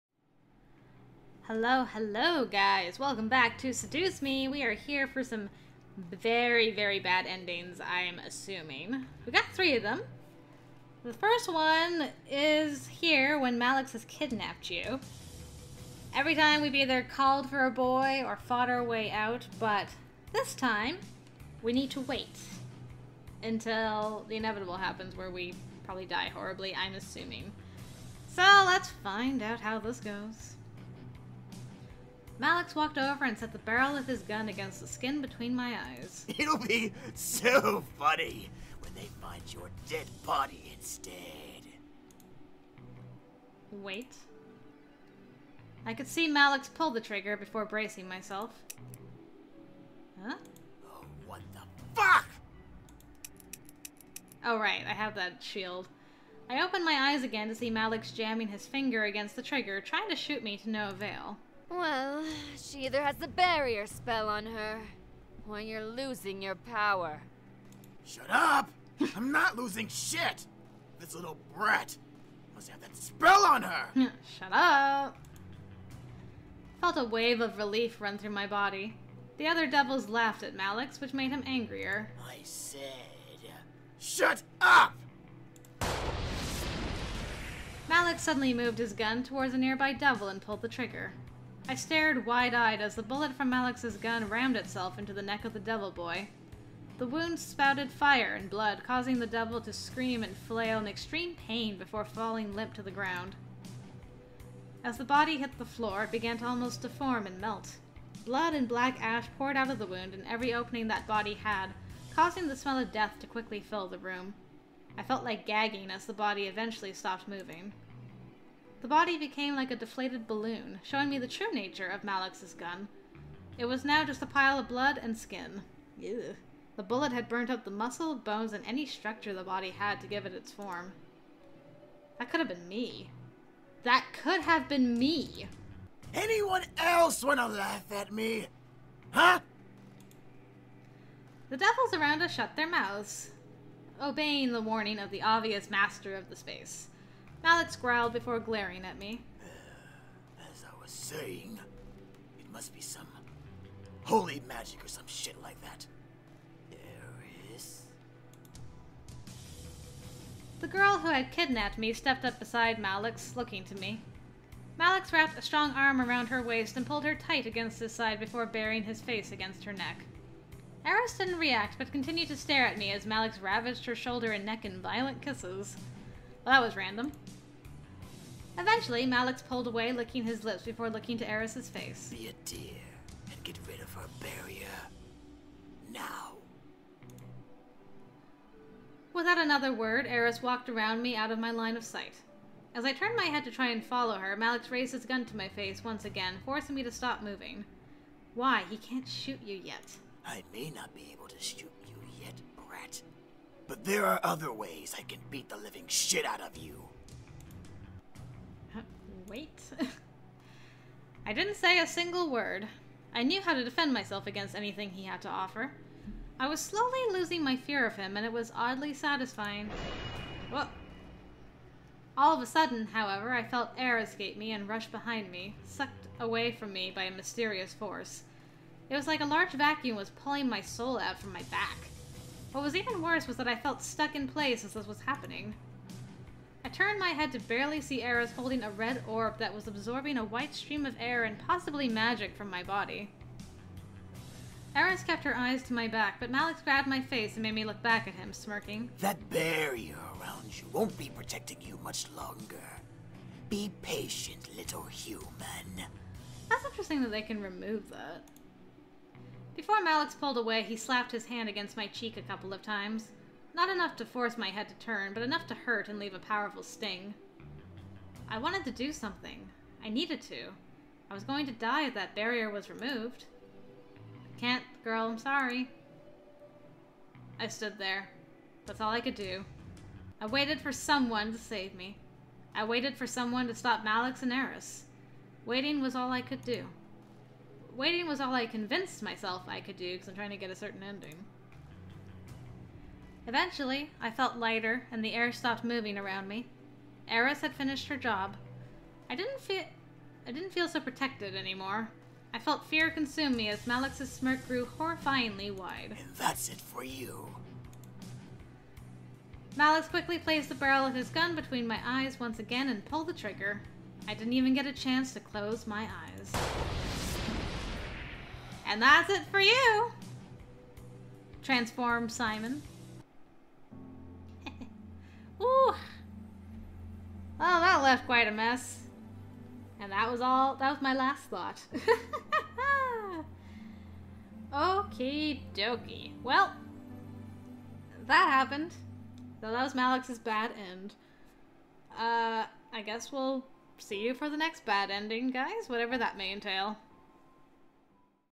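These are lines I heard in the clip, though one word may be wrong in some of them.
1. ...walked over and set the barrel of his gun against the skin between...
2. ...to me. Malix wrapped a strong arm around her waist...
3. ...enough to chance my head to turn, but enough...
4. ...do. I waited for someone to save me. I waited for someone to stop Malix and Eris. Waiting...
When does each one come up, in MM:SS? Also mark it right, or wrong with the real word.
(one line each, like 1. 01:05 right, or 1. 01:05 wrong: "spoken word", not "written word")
1. 00:32 right
2. 02:43 right
3. 04:23 wrong: "force", not "chance"
4. 04:39 right.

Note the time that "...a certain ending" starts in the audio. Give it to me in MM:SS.
04:50.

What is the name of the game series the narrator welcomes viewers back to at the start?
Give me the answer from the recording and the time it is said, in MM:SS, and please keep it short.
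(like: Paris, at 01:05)
Seduce Me, at 00:03.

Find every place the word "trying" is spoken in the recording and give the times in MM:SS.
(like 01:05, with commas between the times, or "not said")
00:59, 04:50.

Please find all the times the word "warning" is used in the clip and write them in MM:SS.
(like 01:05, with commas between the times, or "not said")
02:24.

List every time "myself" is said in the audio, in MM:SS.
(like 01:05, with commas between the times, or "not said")
00:48, 03:33, 04:49.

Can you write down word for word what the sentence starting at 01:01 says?
Well, she either has the barrier spell on her, or you're losing your power.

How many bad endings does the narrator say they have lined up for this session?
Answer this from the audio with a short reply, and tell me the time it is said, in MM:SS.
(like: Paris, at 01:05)
3, at 00:09.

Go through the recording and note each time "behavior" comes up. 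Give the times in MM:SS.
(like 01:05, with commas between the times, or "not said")
not said.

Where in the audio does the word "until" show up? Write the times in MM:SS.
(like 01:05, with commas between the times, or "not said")
00:23.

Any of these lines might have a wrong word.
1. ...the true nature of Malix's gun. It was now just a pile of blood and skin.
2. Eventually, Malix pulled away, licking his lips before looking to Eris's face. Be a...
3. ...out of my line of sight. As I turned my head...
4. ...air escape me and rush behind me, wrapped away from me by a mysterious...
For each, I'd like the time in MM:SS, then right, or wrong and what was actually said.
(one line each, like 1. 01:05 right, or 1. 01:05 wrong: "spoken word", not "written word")
1. 02:01 right
2. 02:58 right
3. 03:11 right
4. 03:43 wrong: "sucked", not "wrapped".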